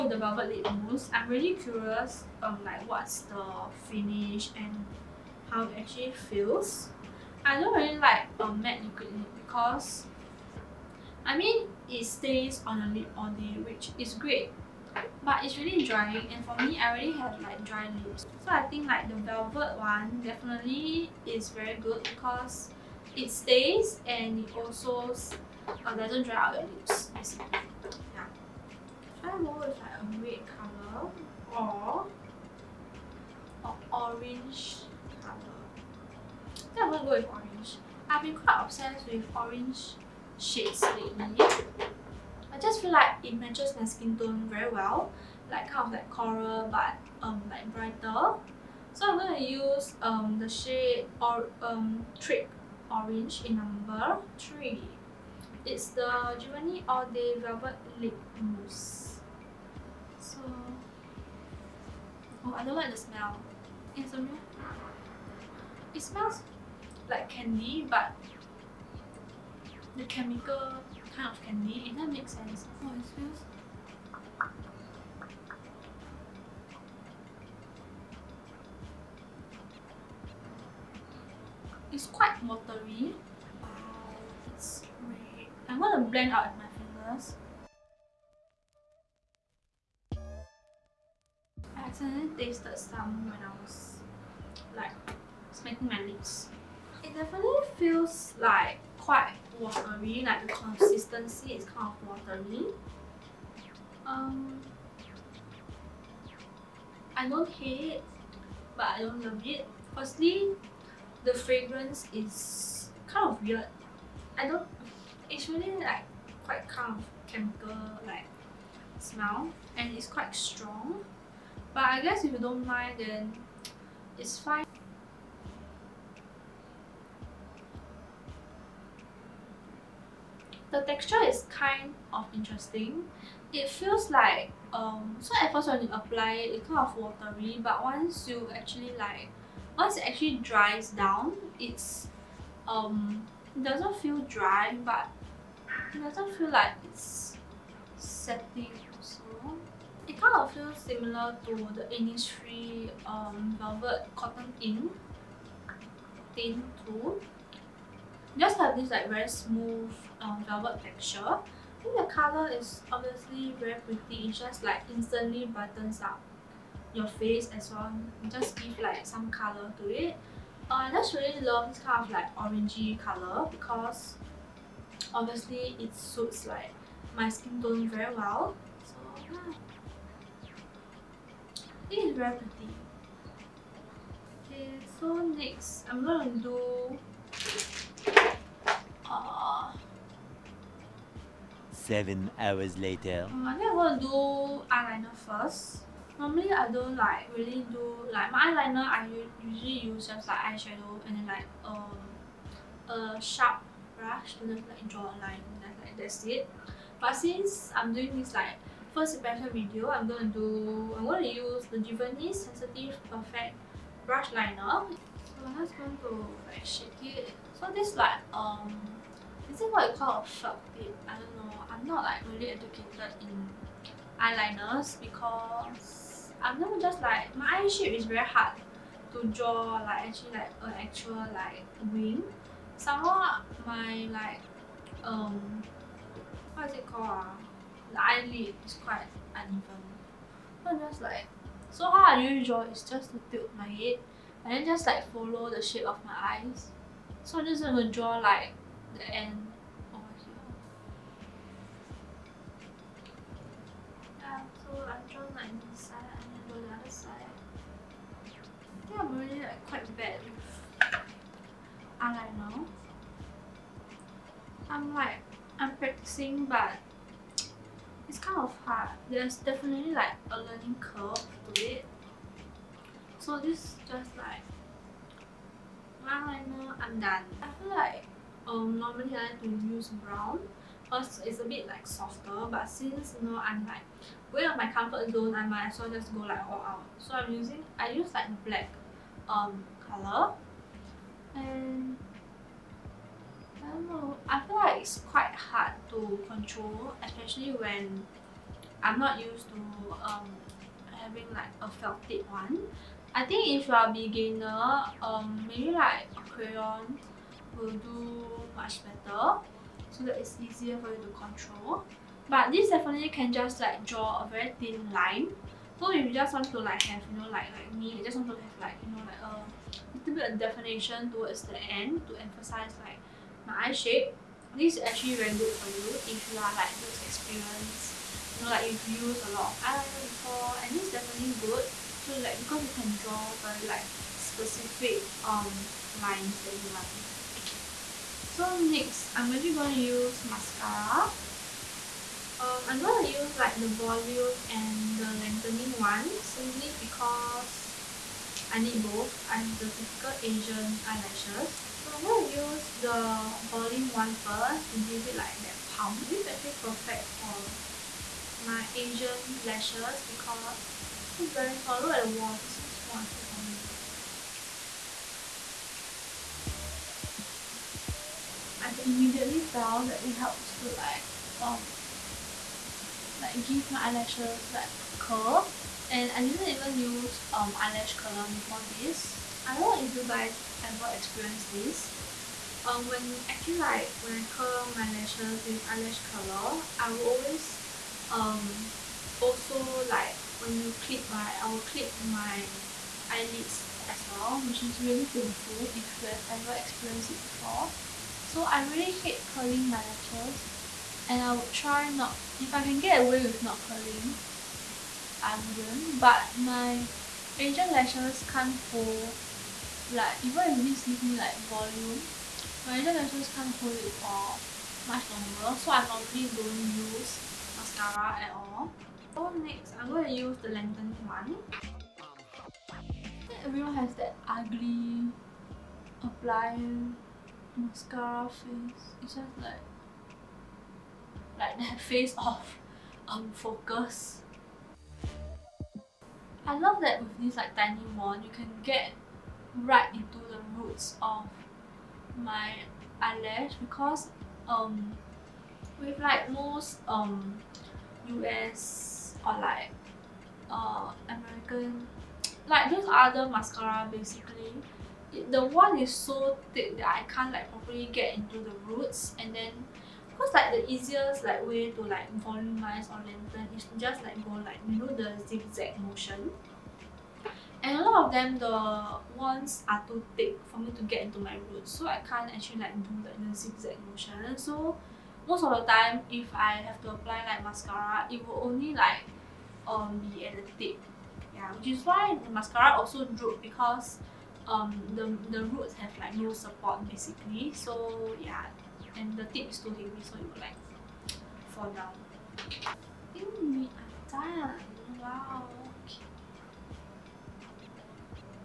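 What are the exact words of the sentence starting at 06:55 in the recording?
So I normally don't use mascara at all.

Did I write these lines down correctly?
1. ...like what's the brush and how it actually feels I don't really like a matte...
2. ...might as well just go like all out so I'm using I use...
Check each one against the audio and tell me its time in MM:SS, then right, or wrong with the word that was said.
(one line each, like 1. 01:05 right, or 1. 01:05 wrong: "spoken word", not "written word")
1. 00:02 wrong: "finish", not "brush"
2. 04:45 right.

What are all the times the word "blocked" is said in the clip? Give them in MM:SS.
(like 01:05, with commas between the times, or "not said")
not said.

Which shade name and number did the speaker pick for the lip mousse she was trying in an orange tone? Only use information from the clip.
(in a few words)
Trick Orange 3.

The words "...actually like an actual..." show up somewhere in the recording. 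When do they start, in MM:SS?
03:50.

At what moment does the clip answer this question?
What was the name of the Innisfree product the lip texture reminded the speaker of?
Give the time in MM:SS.
02:33.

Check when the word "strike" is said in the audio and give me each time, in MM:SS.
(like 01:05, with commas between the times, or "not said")
not said.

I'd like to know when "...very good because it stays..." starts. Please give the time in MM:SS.
00:21.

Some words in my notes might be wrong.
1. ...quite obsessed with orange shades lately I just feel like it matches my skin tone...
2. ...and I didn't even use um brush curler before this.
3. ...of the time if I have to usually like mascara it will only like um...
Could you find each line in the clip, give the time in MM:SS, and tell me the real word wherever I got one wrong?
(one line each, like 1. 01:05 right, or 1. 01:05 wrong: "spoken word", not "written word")
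1. 00:38 right
2. 06:15 wrong: "eyelash", not "brush"
3. 07:55 wrong: "apply", not "usually".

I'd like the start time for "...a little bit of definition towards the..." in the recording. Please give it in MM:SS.
05:19.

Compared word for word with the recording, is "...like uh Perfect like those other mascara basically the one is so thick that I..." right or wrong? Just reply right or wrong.
wrong.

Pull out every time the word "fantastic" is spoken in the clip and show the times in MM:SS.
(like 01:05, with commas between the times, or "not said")
not said.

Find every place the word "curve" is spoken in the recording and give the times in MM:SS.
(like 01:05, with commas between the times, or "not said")
04:30.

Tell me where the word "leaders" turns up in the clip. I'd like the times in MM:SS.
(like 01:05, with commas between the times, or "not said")
not said.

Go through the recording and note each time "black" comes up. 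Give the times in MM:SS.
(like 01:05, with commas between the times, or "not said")
04:48.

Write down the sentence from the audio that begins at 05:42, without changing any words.
Um, I'm going to use like the volume and the lengthening one simply because I need both.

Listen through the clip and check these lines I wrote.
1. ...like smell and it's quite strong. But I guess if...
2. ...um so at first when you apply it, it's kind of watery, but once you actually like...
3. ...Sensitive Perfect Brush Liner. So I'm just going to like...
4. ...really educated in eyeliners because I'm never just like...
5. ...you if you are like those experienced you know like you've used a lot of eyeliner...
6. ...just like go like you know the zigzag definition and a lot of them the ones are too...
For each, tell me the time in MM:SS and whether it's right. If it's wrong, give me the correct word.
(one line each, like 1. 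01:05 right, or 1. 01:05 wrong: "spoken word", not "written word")
1. 01:58 right
2. 02:14 right
3. 03:32 right
4. 03:42 right
5. 05:25 right
6. 07:43 wrong: "motion", not "definition".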